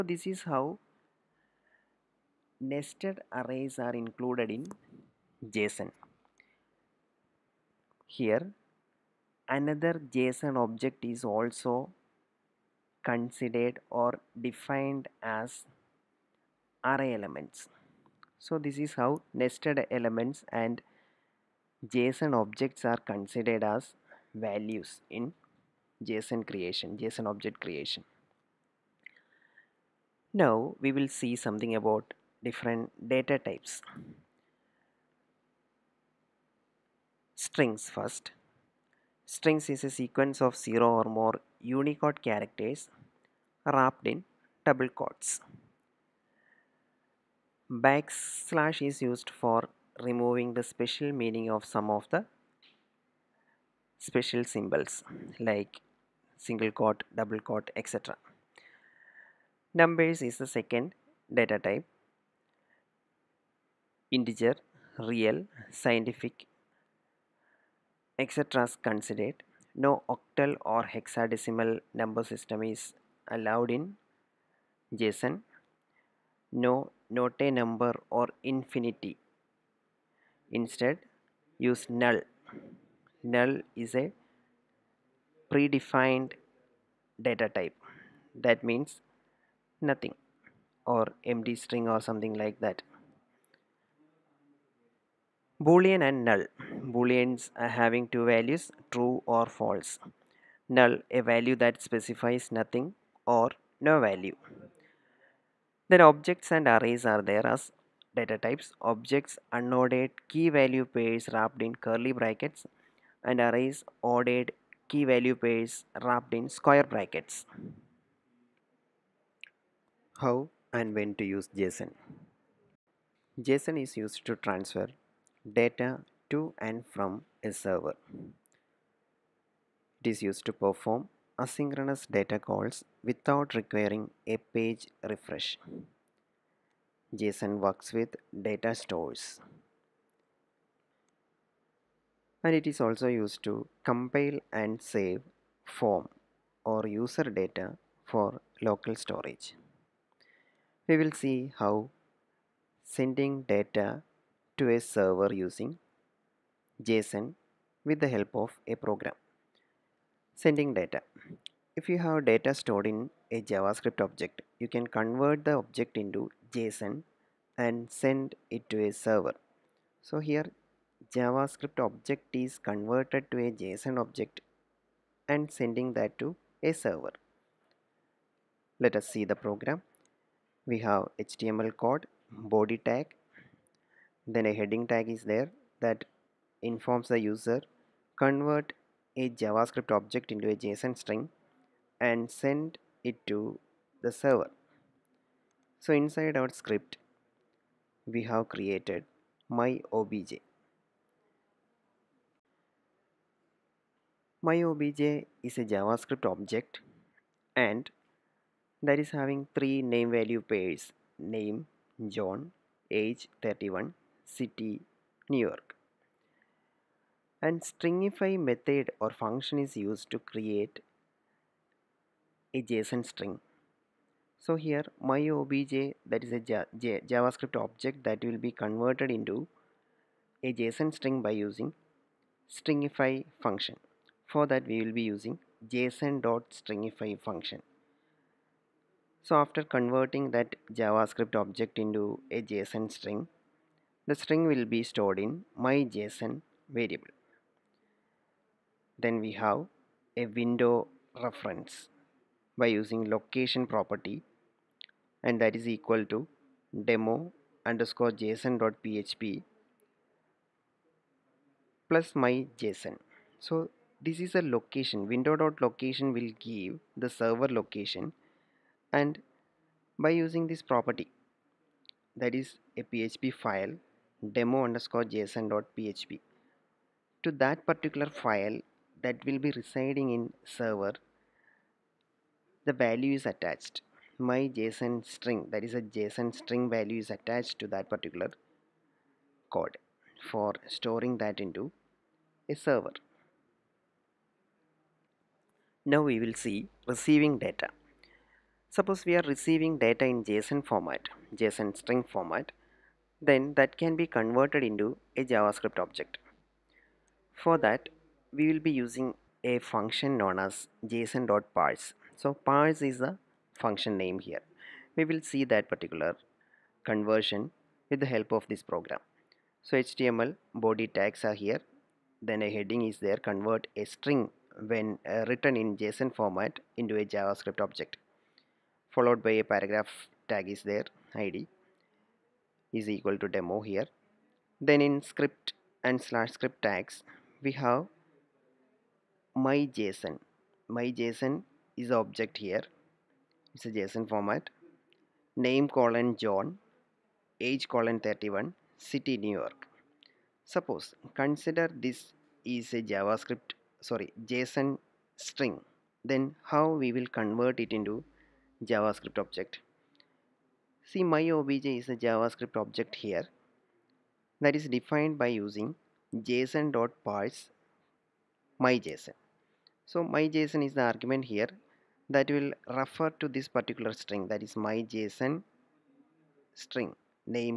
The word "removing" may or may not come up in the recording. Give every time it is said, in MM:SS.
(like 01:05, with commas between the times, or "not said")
00:49.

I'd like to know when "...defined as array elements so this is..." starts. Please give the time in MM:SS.
00:14.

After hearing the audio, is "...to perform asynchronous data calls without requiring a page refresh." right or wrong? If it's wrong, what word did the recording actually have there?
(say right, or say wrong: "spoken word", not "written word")
right.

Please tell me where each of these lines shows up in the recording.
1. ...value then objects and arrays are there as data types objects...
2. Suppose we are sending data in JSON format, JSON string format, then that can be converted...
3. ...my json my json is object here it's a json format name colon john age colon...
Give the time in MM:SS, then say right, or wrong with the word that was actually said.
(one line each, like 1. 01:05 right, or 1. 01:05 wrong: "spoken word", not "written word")
1. 01:44 right
2. 04:58 wrong: "receiving", not "sending"
3. 05:39 right.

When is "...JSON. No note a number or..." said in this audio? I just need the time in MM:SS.
01:14.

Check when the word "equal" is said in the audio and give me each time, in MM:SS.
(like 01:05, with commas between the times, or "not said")
04:15, 05:32.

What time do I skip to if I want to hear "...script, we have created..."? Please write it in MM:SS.
03:16.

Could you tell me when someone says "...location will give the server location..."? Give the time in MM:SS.
04:25.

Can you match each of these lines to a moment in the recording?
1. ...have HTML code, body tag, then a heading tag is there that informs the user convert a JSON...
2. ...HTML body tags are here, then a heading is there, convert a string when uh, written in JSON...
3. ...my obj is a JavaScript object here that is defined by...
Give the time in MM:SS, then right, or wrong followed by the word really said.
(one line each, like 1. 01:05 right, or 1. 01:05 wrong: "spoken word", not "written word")
1. 03:00 wrong: "JavaScript", not "JSON"
2. 05:19 right
3. 06:01 right.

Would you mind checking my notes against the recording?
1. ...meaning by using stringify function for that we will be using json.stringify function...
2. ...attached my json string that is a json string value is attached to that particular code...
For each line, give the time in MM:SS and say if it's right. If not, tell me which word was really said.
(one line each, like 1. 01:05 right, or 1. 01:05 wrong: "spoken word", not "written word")
1. 03:50 wrong: "string", not "meaning"
2. 04:43 right.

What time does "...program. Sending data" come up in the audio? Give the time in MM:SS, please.
02:38.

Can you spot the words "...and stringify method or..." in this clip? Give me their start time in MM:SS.
03:37.